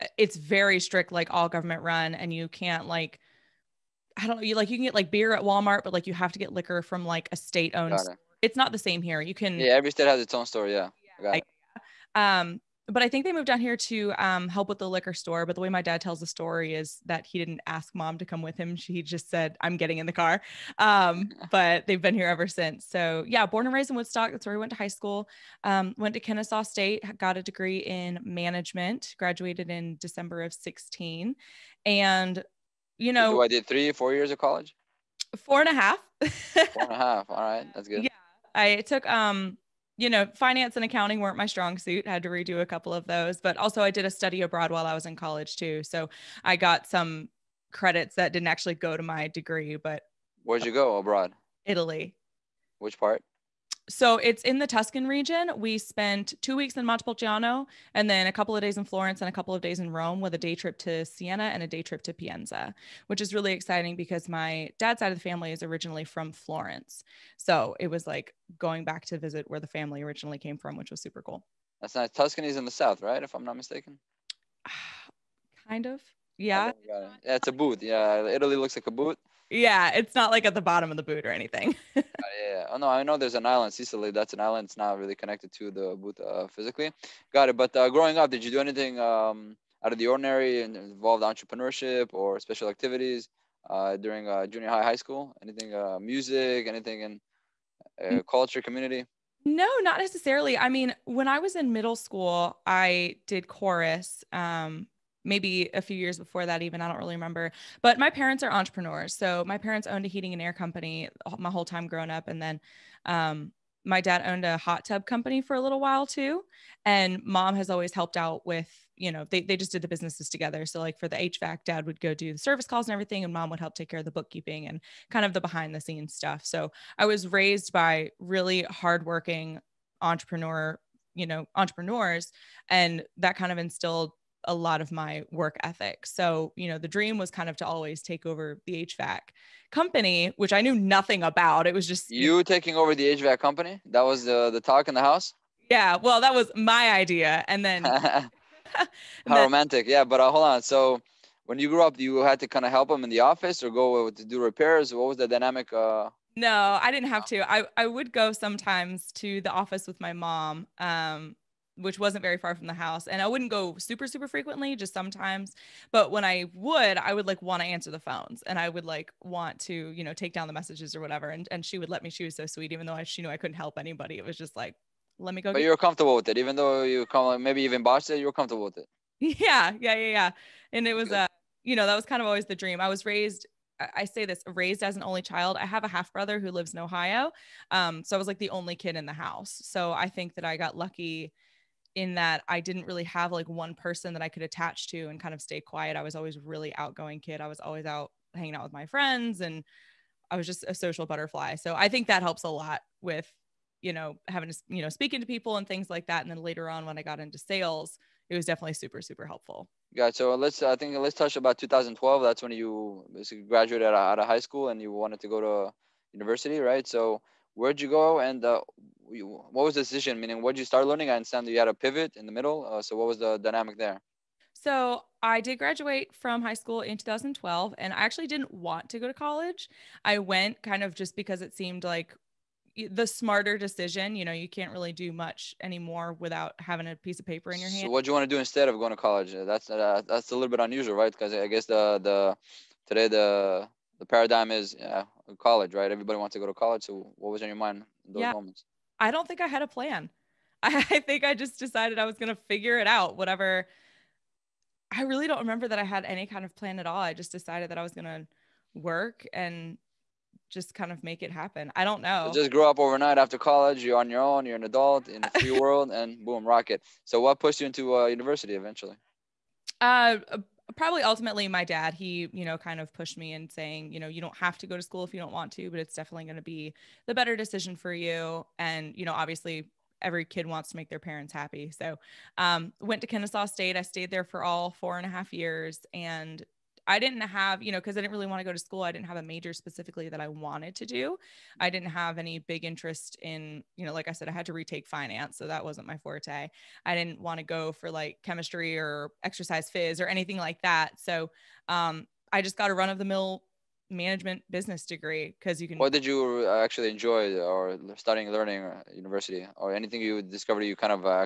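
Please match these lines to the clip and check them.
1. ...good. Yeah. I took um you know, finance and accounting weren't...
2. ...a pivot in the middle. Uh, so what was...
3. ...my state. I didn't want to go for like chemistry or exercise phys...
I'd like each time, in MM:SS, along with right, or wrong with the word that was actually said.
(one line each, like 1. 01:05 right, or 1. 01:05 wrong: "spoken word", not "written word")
1. 00:37 right
2. 03:41 right
3. 04:55 wrong: "forte", not "state".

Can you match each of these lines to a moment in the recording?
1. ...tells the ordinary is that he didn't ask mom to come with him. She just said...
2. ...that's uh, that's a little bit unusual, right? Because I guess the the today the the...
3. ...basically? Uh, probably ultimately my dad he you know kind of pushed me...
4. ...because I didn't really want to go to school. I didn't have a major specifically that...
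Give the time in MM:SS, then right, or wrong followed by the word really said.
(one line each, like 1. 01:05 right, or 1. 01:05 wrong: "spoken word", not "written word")
1. 00:16 wrong: "story", not "ordinary"
2. 03:59 right
3. 04:28 wrong: "eventually", not "basically"
4. 04:47 right.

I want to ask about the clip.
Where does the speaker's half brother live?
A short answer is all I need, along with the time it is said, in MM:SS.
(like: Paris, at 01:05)
Ohio, at 03:06.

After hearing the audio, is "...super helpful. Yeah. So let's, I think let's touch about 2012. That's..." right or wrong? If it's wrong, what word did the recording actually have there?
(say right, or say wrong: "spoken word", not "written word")
right.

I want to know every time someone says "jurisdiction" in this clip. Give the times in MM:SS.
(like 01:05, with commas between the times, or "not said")
not said.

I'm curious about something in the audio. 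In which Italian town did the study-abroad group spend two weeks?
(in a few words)
Montepulciano.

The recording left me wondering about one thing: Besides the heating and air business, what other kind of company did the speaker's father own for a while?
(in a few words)
Hot tub company.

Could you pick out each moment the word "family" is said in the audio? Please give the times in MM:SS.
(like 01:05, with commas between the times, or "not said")
01:05, 01:09.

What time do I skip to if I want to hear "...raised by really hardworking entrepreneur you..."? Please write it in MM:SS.
02:07.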